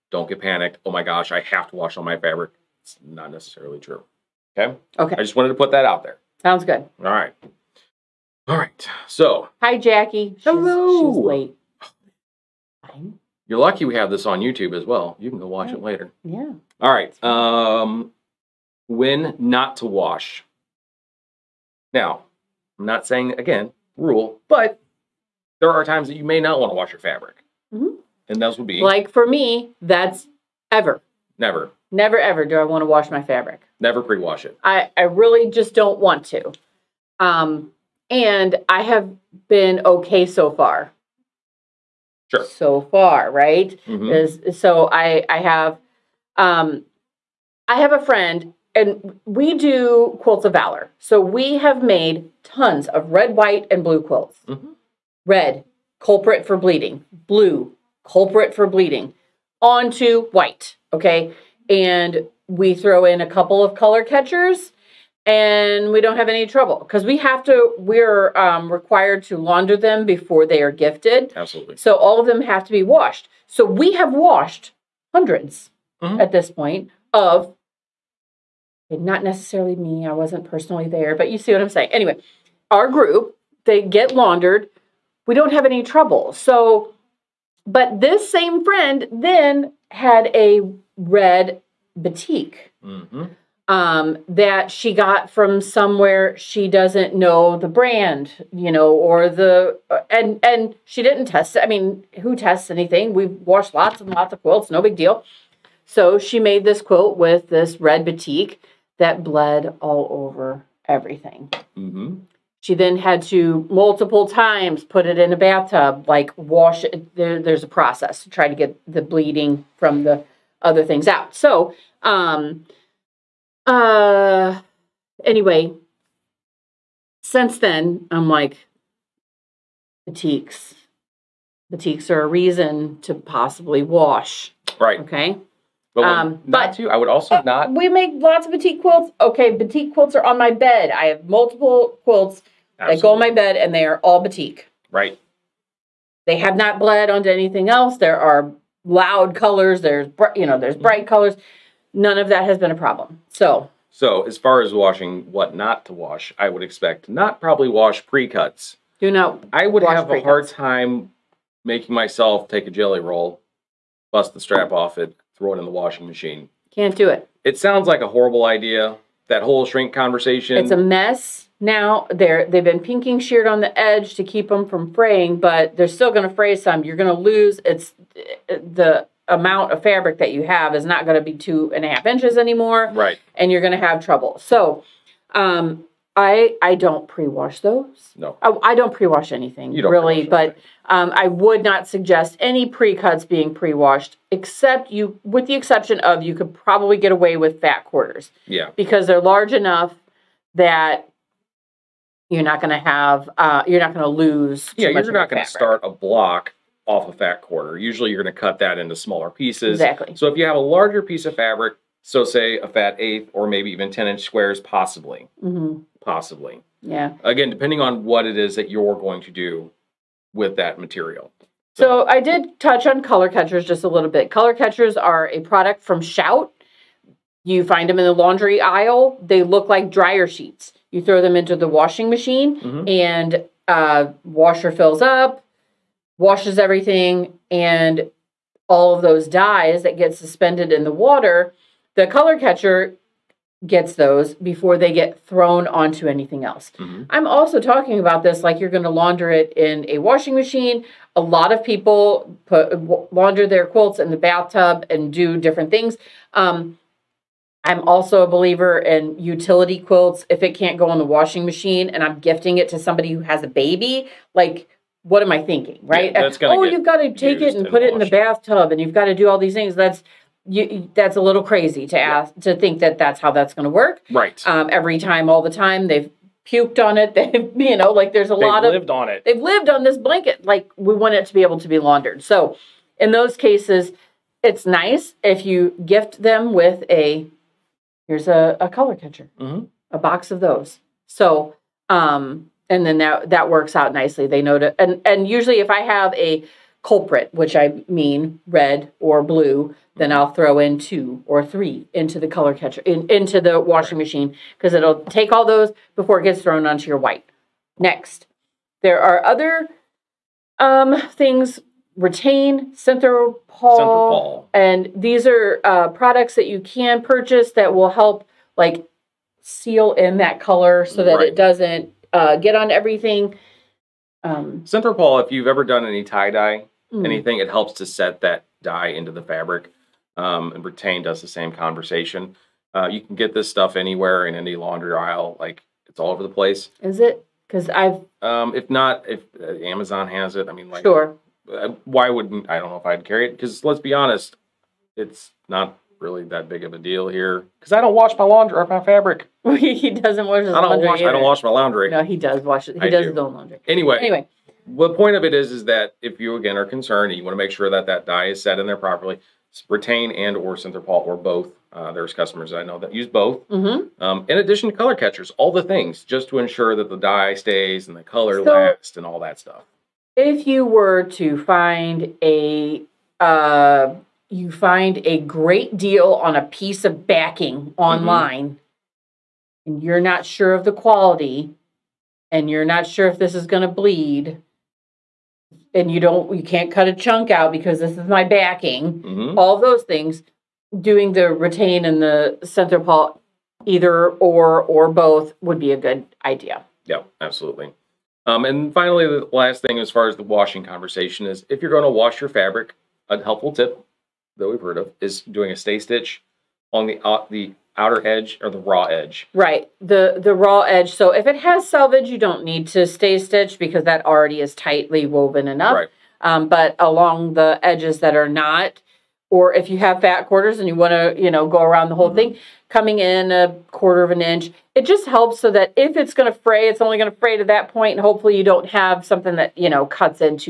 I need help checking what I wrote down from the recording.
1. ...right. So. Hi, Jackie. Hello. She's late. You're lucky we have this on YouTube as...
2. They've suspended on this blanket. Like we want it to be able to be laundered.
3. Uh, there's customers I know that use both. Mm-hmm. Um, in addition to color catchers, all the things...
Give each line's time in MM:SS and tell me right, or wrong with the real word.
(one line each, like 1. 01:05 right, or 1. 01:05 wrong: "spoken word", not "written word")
1. 00:08 right
2. 04:39 wrong: "lived", not "suspended"
3. 06:01 right.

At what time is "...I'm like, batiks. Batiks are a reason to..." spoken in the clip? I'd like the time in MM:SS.
02:08.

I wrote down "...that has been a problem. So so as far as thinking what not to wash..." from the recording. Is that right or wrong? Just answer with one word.
wrong.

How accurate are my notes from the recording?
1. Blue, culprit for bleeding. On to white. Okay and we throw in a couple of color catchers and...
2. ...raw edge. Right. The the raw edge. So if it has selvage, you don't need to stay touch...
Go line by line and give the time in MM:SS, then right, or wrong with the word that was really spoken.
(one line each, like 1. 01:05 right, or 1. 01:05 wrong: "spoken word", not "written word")
1. 00:57 right
2. 06:48 wrong: "stitch", not "touch".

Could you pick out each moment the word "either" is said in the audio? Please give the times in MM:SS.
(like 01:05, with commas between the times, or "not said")
05:51, 06:33.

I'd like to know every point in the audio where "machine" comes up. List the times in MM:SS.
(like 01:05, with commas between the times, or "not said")
02:46, 03:52, 04:10, 04:21, 05:03.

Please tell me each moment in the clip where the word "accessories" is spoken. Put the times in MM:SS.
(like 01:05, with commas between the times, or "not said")
not said.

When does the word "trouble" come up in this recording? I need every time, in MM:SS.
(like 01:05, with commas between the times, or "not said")
01:06, 01:25, 03:04.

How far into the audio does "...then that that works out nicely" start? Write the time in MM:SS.
04:52.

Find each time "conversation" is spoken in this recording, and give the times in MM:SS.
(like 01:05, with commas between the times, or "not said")
02:49, 05:31, 06:40.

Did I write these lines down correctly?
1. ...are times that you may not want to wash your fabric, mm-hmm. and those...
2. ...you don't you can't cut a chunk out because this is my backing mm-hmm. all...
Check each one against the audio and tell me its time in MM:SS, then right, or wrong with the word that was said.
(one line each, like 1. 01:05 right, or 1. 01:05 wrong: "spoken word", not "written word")
1. 00:25 right
2. 06:25 right.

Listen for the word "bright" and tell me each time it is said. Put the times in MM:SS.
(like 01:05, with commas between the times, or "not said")
02:30.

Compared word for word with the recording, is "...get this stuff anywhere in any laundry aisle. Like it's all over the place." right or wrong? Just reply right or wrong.
right.